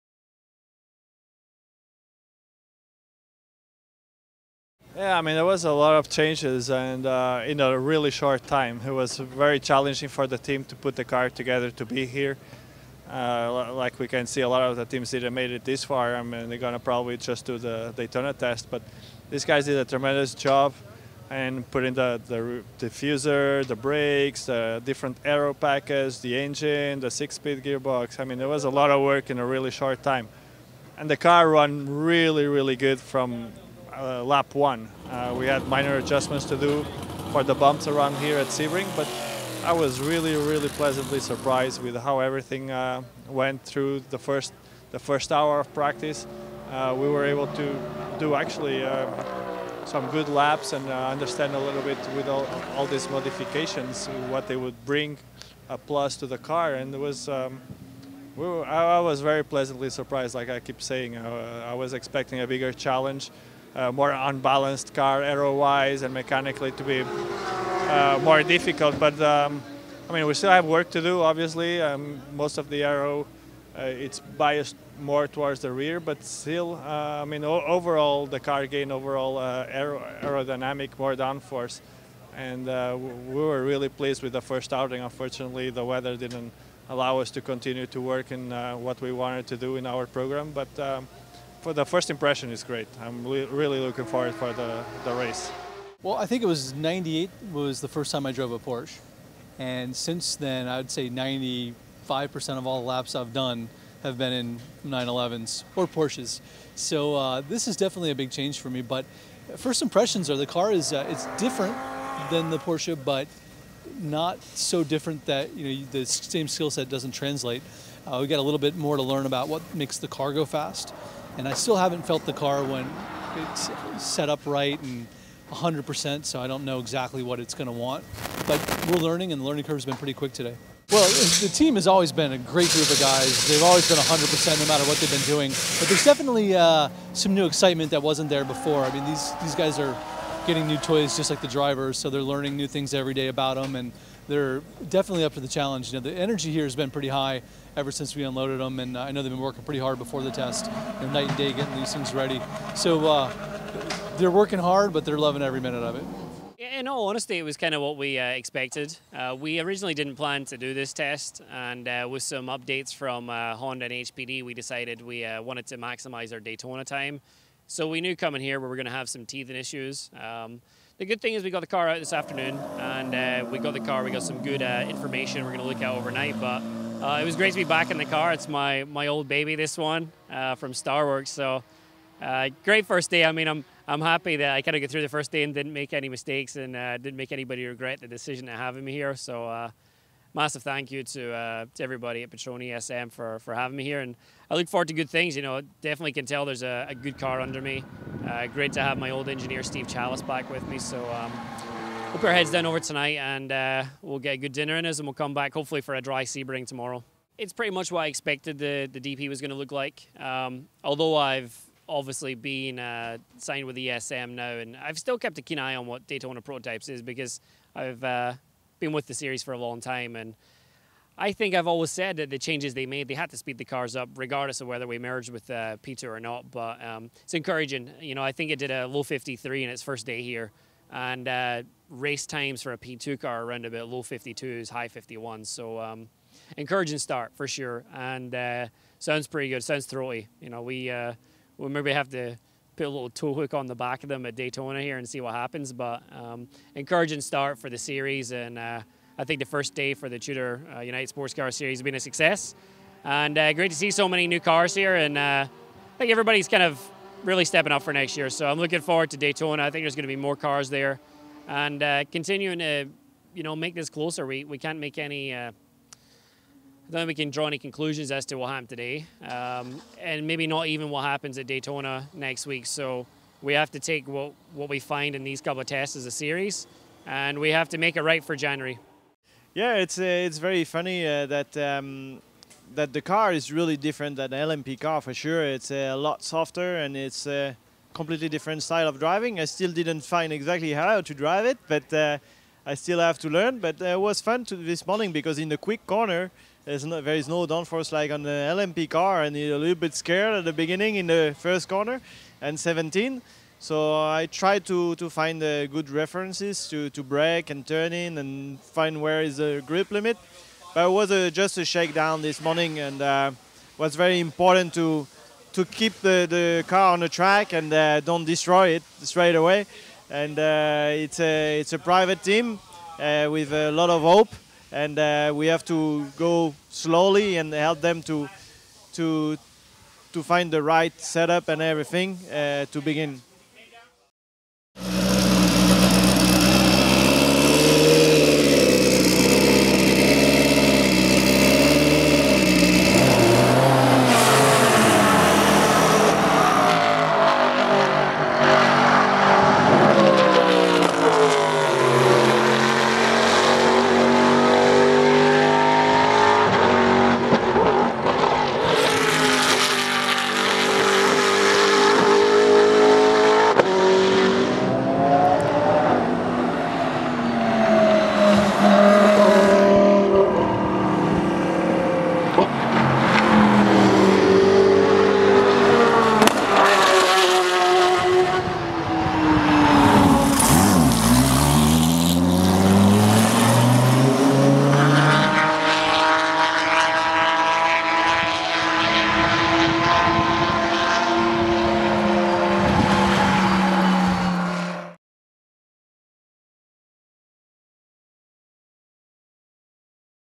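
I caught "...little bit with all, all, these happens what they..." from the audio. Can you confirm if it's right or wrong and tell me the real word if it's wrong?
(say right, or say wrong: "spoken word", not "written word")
wrong: "modifications", not "happens".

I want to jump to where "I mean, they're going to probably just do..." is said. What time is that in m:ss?
0:16.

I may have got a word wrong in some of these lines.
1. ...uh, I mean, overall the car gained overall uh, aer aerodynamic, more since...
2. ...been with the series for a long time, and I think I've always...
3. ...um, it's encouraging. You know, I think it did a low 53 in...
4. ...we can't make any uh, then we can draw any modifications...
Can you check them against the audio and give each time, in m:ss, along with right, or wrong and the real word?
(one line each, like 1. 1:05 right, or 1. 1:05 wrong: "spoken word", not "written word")
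1. 1:16 wrong: "downforce", not "since"
2. 3:38 right
3. 3:46 right
4. 4:24 wrong: "conclusions", not "modifications".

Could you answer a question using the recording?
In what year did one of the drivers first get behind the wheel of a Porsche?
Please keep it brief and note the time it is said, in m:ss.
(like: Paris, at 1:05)
1998, at 1:36.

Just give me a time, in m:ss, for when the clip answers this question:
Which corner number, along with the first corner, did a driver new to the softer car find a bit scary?
5:02.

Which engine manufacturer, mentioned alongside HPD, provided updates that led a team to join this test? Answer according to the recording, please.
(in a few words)
Honda.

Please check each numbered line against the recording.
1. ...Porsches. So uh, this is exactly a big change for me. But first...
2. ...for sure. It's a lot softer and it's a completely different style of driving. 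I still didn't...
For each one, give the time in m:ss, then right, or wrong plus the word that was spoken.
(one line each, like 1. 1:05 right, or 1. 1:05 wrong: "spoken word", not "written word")
1. 1:45 wrong: "definitely", not "exactly"
2. 4:45 right.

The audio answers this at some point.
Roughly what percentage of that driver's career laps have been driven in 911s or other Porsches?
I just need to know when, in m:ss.
1:41.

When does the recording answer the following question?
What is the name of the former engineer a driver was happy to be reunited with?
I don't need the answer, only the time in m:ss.
3:19.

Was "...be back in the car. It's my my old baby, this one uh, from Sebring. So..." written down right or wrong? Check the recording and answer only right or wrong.
wrong.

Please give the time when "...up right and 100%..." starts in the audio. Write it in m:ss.
2:04.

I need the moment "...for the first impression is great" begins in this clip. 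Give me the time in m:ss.
1:31.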